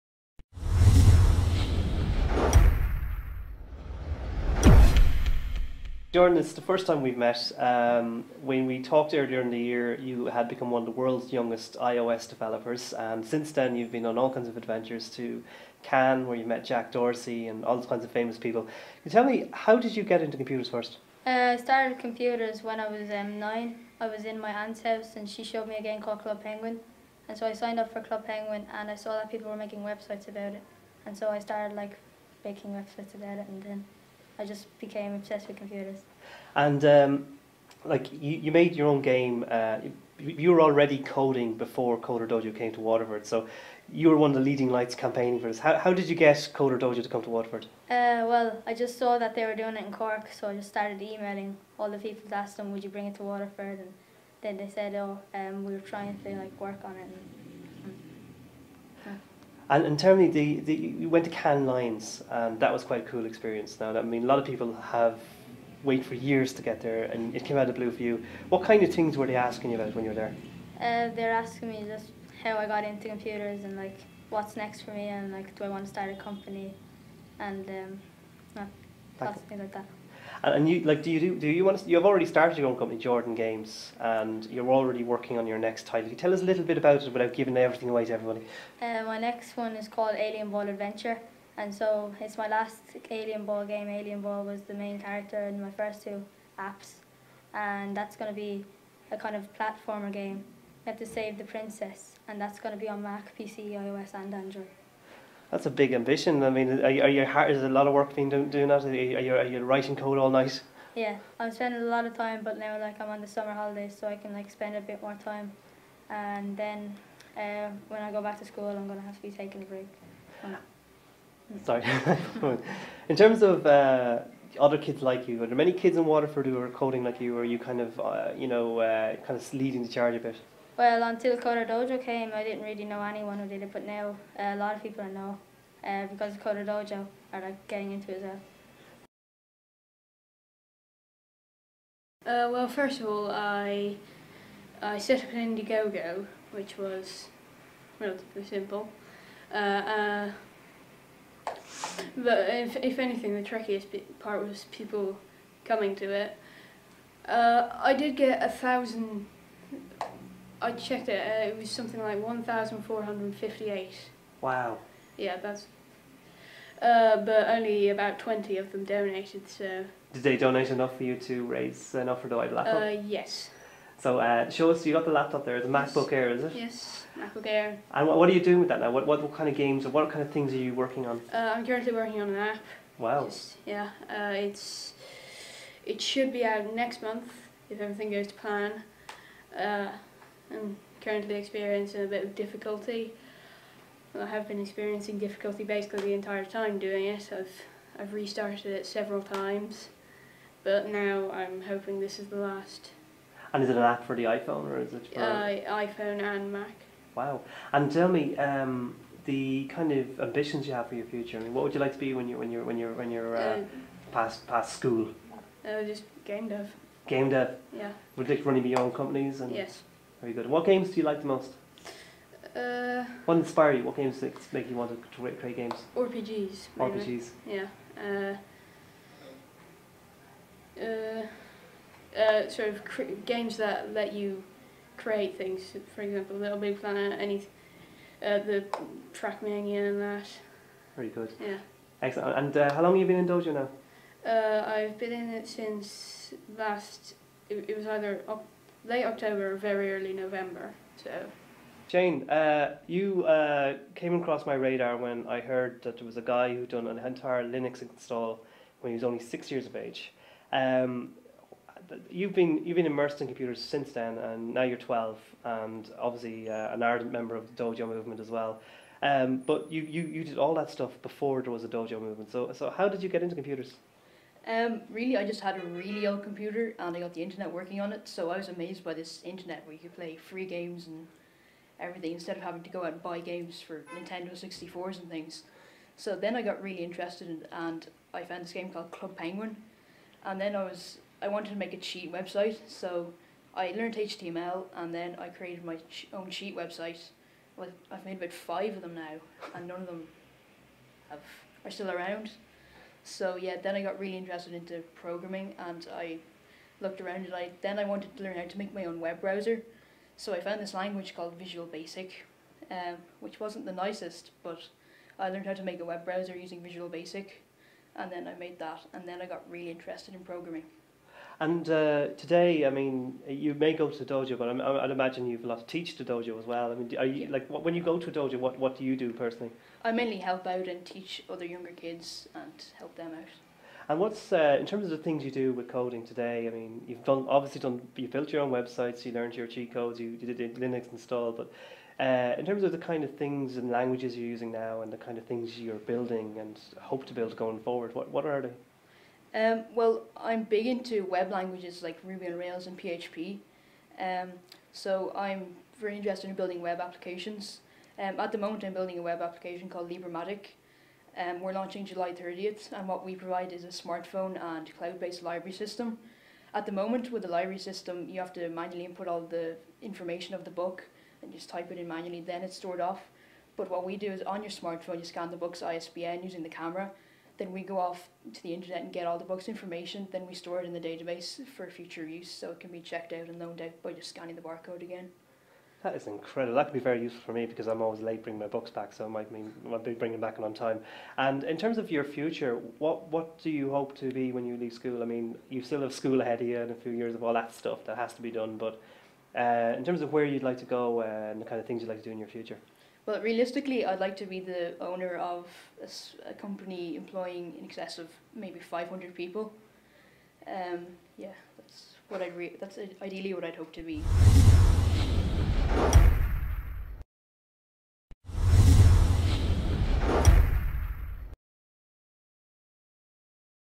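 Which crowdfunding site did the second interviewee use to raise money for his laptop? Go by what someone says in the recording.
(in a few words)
Indiegogo.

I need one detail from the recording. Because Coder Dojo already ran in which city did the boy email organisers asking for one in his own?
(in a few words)
Cork.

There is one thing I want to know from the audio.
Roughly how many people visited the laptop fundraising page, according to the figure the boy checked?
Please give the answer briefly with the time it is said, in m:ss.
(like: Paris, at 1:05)
1,458, at 2:42.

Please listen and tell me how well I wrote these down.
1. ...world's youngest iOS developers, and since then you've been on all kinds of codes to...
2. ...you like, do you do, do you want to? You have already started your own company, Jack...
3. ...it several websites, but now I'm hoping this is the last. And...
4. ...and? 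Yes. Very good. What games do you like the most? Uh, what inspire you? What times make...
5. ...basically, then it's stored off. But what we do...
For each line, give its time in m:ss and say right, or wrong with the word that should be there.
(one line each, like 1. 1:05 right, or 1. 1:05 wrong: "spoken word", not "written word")
1. 0:10 wrong: "adventures", not "codes"
2. 1:20 wrong: "Jordan", not "Jack"
3. 3:18 wrong: "times", not "websites"
4. 3:39 wrong: "games", not "times"
5. 6:11 wrong: "manually", not "basically".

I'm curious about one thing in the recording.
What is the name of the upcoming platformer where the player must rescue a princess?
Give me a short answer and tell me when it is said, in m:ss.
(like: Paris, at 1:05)
Alien Ball Adventure, at 1:30.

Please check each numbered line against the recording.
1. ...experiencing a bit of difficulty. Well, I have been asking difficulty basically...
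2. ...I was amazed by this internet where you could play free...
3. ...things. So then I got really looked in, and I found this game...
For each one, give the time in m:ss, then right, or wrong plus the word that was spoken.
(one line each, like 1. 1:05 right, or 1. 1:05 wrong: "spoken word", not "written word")
1. 3:11 wrong: "experiencing", not "asking"
2. 4:38 right
3. 4:45 wrong: "interested", not "looked".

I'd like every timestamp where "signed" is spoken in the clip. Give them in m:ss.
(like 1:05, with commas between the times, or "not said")
0:27.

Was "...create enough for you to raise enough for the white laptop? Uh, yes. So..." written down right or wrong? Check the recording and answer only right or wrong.
wrong.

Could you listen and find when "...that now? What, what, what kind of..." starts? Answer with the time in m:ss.
2:58.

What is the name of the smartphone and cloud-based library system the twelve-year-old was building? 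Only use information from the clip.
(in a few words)
Libramatic.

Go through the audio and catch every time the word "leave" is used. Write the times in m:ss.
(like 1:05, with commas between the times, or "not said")
6:34.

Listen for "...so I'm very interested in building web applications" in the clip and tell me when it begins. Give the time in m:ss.
5:54.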